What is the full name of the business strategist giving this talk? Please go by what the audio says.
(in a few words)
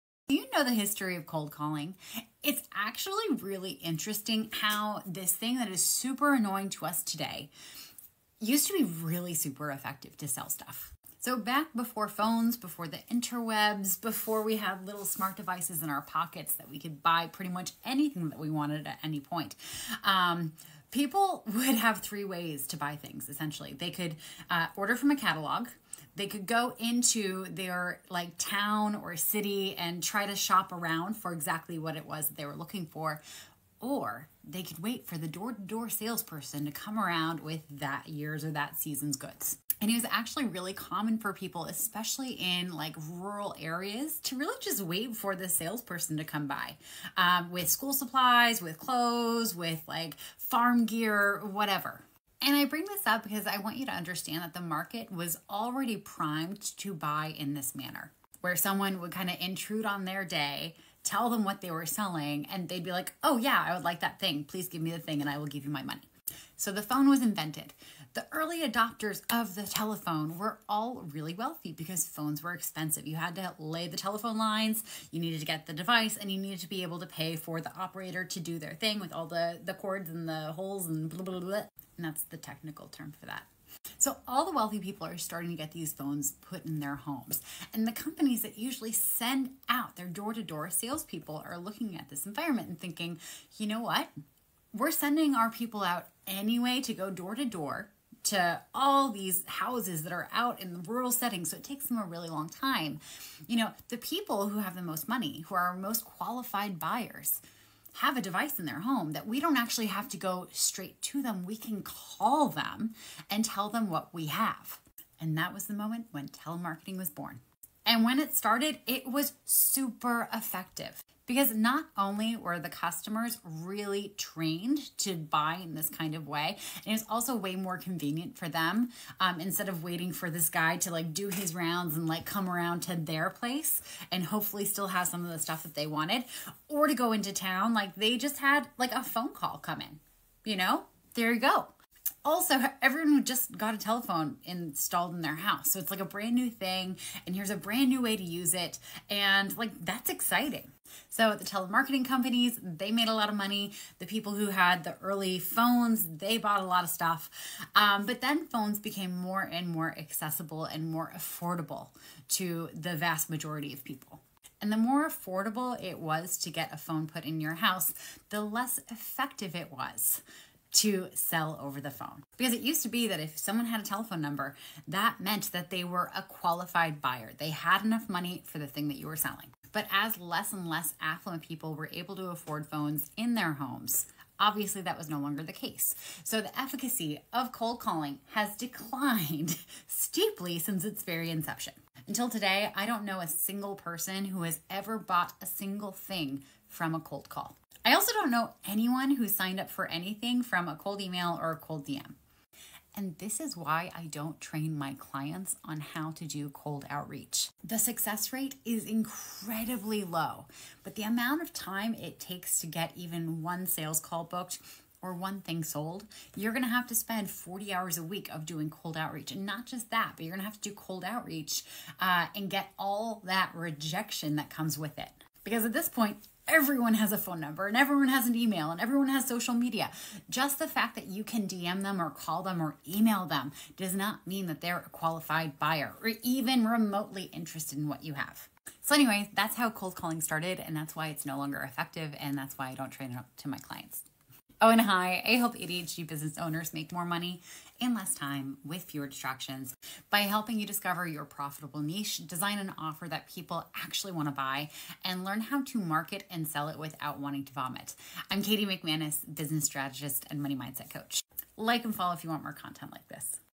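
Katie McManus.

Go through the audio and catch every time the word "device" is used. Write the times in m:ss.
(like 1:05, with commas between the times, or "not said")
0:15, 1:15, 1:48.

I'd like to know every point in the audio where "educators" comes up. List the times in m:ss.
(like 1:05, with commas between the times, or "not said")
not said.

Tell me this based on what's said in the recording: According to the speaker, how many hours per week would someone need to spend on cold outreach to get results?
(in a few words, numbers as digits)
40.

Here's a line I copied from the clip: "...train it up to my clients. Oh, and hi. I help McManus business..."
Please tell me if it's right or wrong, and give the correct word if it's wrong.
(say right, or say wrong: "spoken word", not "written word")
wrong: "ADHD", not "McManus".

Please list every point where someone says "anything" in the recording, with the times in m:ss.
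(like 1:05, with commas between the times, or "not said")
0:17, 3:19.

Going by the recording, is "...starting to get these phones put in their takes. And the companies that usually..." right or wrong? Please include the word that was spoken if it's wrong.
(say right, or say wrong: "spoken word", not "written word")
wrong: "homes", not "takes".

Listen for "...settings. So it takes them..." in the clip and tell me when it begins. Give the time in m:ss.
1:41.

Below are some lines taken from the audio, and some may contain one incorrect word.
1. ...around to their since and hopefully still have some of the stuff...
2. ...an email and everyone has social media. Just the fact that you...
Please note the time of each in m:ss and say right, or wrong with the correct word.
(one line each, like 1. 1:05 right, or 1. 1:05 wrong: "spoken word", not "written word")
1. 2:12 wrong: "place", not "since"
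2. 3:48 right.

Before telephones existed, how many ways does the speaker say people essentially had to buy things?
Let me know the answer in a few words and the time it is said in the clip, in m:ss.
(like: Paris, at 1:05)
3, at 0:21.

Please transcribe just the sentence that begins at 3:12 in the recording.
Until today, I don't know a single person who has ever bought a single thing from a cold call.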